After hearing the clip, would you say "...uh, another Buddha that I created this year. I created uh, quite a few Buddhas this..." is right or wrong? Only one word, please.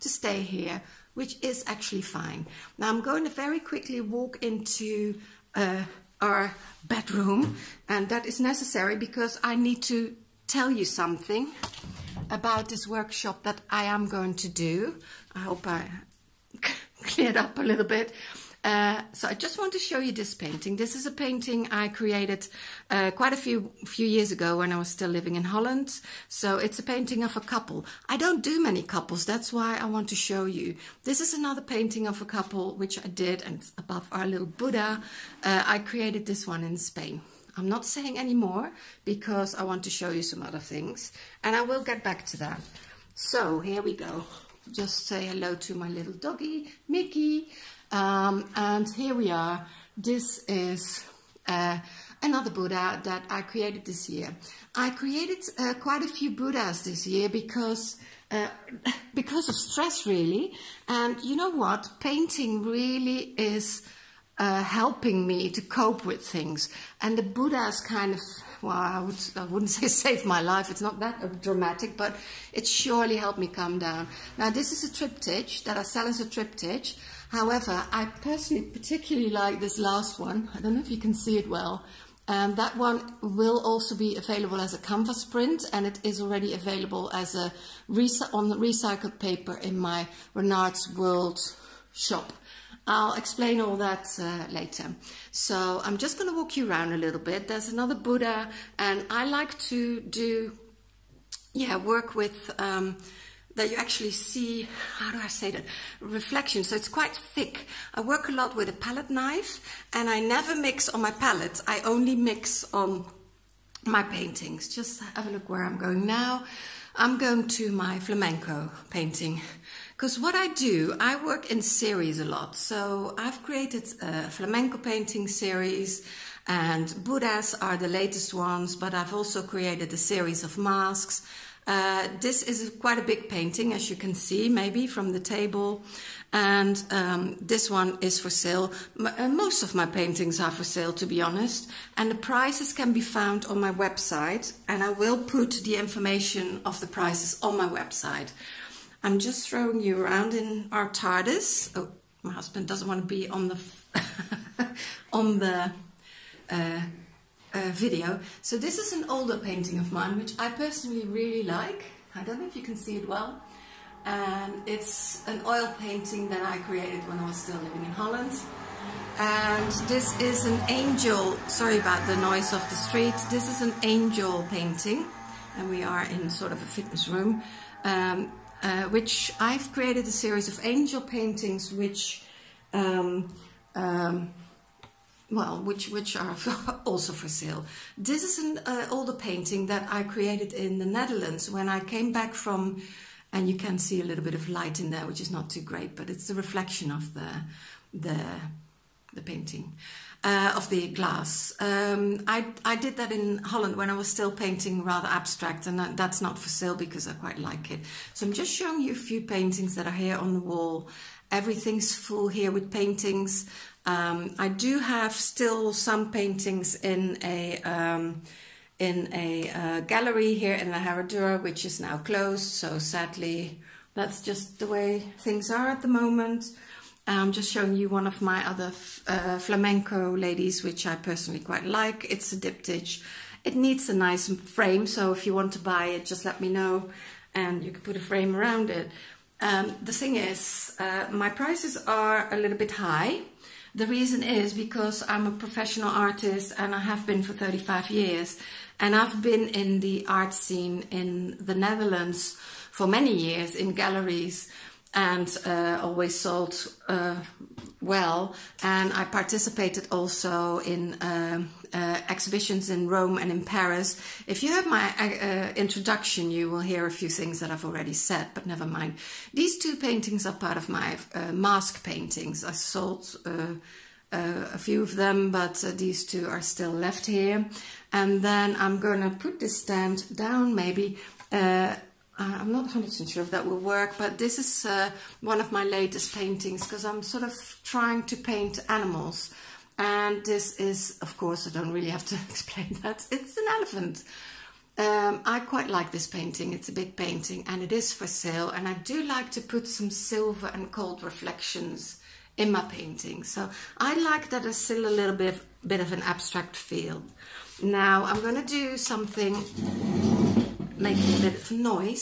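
right.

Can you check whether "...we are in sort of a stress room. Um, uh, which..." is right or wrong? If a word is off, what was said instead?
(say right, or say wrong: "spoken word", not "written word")
wrong: "fitness", not "stress".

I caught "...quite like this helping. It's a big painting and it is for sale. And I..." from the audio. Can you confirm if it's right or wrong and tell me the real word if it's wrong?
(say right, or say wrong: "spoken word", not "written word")
wrong: "painting", not "helping".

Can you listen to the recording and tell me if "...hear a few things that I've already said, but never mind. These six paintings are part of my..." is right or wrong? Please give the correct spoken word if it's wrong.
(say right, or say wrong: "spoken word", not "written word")
wrong: "two", not "six".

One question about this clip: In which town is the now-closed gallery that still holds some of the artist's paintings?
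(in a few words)
La Herradura.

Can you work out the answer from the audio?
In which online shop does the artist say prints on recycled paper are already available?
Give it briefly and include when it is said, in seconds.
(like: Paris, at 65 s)
Renart's World, at 90 s.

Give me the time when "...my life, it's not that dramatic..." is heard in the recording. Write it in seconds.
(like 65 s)
70 s.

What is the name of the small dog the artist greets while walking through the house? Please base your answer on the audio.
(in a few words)
Mickey.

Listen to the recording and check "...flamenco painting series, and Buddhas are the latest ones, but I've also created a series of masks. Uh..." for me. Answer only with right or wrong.
right.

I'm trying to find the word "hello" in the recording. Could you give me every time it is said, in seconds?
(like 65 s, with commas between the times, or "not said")
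45 s.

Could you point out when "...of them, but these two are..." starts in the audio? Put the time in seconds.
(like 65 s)
274 s.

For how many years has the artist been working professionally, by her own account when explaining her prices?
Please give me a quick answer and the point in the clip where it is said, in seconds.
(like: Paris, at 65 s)
35, at 247 s.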